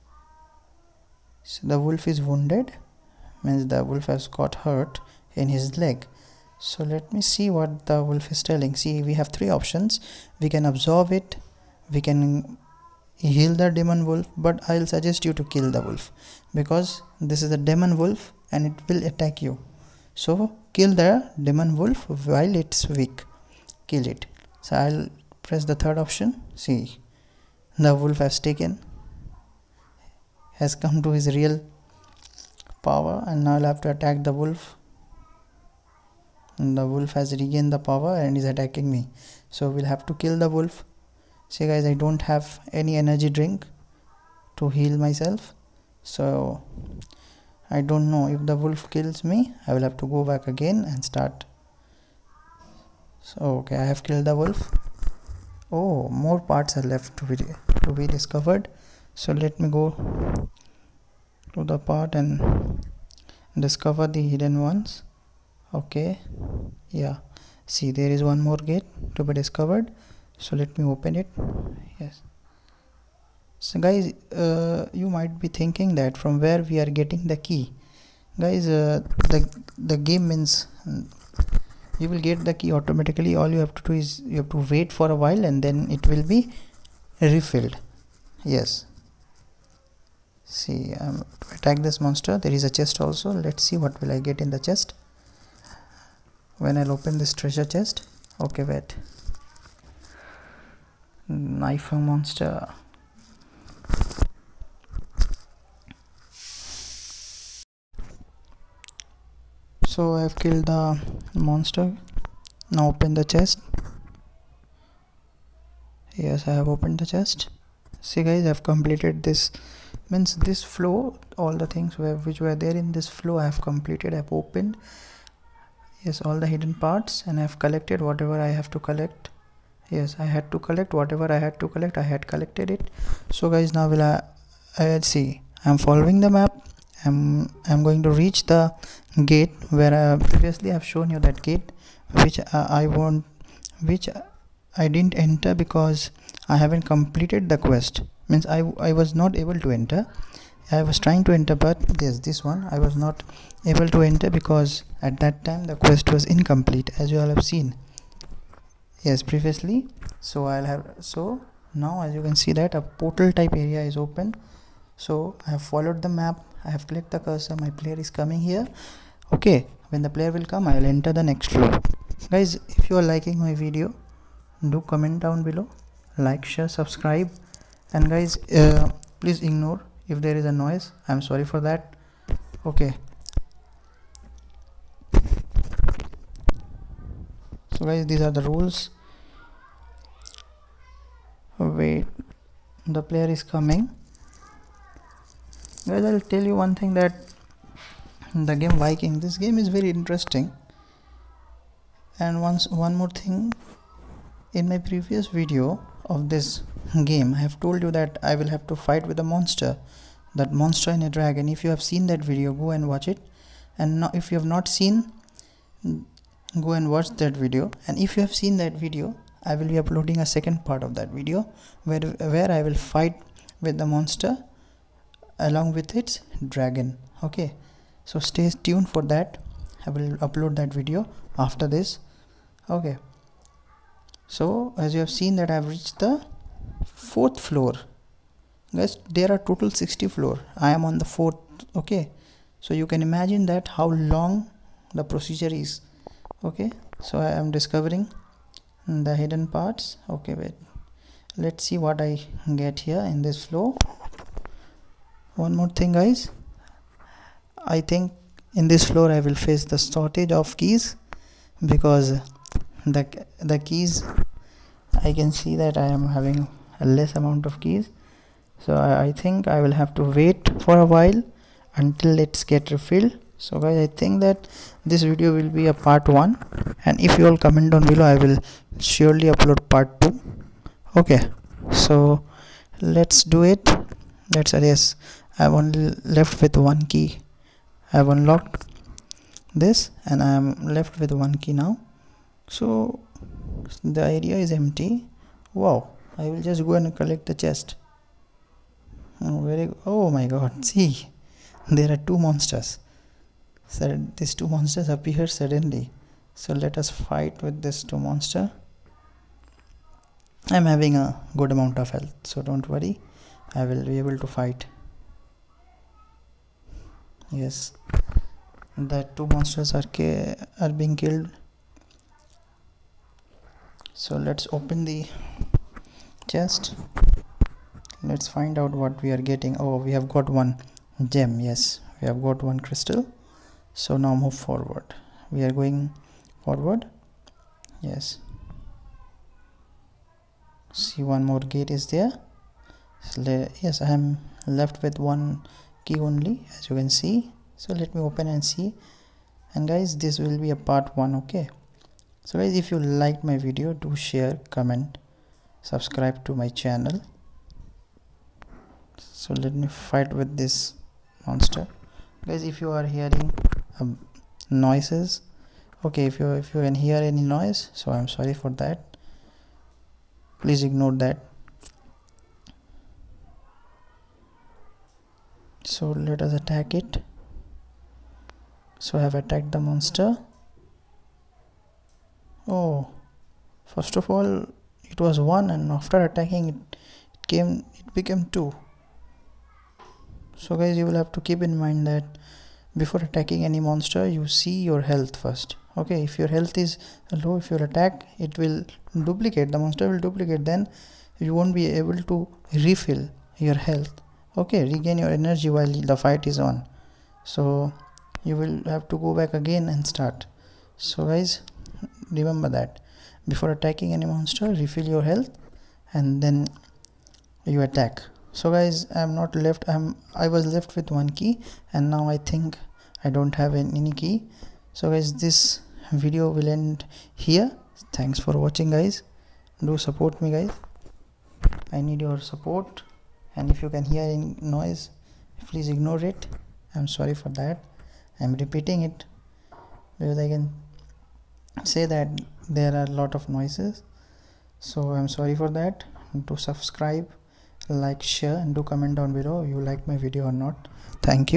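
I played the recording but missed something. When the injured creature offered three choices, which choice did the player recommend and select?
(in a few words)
Kill the demon wolf.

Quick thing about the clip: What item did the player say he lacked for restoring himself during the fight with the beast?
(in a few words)
Energy drink.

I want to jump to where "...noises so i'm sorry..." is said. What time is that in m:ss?
7:23.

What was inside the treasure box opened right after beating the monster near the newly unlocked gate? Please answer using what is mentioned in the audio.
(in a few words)
Knife.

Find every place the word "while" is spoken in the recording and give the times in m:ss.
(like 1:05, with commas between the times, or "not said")
0:22, 1:25, 4:30, 6:45.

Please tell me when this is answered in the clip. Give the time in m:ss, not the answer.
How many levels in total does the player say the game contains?
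3:59.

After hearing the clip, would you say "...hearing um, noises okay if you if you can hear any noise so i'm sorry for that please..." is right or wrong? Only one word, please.
right.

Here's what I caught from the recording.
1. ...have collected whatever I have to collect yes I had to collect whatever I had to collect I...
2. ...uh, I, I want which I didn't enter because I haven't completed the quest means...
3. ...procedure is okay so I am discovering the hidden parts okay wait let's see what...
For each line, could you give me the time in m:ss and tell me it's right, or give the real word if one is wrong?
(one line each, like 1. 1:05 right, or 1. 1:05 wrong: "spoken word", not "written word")
1. 2:07 right
2. 2:22 right
3. 4:05 right.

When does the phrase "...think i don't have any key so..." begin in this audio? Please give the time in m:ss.
7:02.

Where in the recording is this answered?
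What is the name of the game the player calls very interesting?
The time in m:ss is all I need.
3:18.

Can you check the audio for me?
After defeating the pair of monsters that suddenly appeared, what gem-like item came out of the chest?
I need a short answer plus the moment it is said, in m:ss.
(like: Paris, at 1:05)
Crystal, at 5:32.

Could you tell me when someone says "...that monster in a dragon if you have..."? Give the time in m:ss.
3:30.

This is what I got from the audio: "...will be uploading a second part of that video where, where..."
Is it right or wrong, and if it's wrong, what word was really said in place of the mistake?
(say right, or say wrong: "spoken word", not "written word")
right.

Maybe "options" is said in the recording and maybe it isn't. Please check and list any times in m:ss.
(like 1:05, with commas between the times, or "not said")
0:09, 0:26.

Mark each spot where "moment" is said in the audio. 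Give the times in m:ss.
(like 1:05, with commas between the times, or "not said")
not said.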